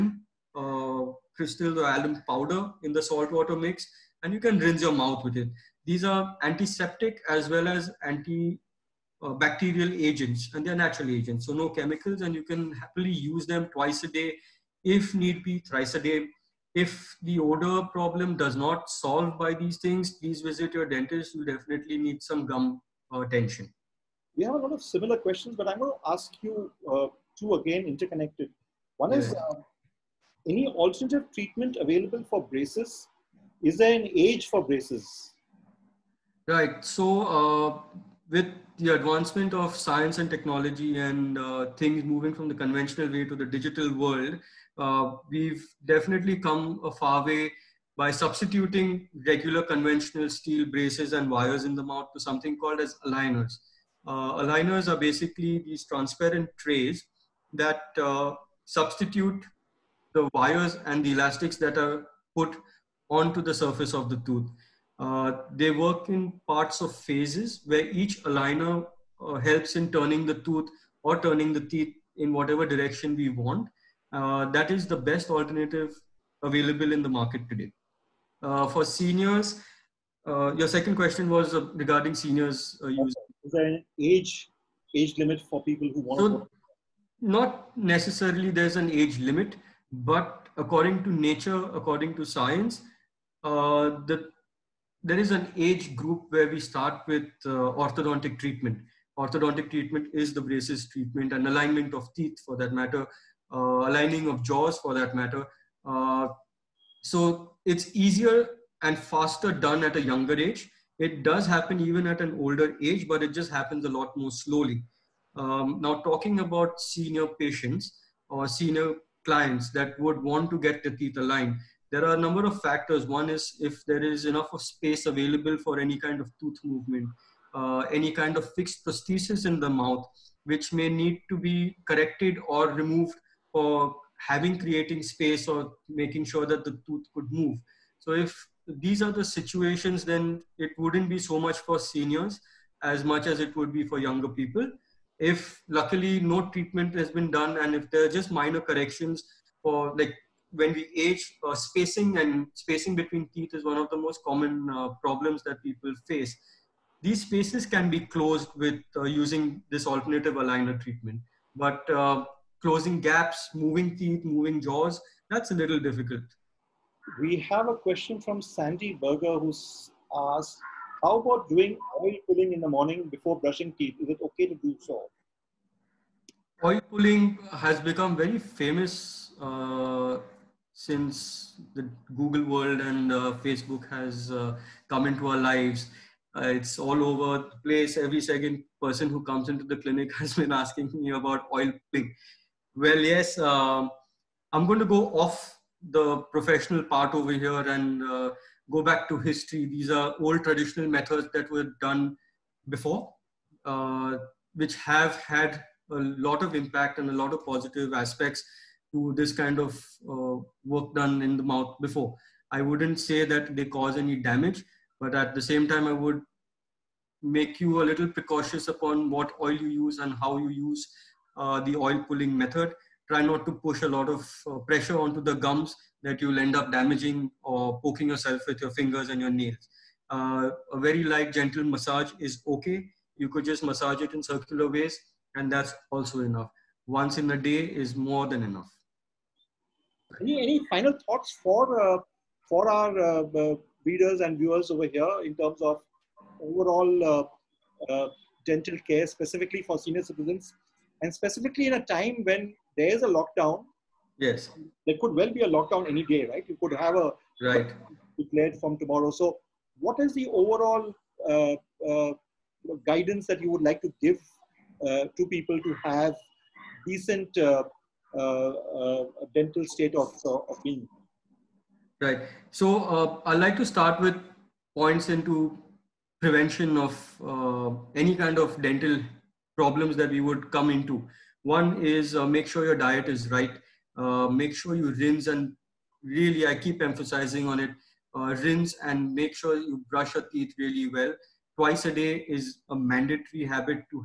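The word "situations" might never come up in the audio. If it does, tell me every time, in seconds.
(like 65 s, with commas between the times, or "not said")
139 s.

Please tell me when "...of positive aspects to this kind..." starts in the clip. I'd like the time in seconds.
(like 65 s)
207 s.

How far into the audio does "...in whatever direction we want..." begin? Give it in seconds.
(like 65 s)
72 s.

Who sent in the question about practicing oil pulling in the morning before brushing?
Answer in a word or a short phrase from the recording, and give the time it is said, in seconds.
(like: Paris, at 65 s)
Sandy Berger, at 168 s.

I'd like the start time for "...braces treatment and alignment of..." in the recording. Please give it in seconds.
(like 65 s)
100 s.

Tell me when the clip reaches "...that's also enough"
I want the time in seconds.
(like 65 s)
235 s.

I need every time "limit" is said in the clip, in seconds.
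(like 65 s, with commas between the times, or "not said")
85 s, 89 s.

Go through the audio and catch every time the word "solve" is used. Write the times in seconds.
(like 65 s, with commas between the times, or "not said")
18 s.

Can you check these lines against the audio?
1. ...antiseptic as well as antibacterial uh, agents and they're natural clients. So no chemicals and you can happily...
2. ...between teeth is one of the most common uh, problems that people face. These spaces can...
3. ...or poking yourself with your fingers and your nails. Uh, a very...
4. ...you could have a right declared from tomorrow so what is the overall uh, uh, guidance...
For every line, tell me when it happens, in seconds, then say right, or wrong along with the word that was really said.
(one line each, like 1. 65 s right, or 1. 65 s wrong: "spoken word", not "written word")
1. 6 s wrong: "agents", not "clients"
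2. 152 s right
3. 227 s right
4. 256 s right.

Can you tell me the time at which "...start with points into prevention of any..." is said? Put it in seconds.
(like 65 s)
273 s.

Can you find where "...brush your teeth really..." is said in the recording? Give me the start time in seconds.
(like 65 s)
289 s.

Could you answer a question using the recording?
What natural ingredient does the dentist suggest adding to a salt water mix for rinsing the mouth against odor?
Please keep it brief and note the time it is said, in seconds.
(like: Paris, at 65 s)
Alum, at 1 s.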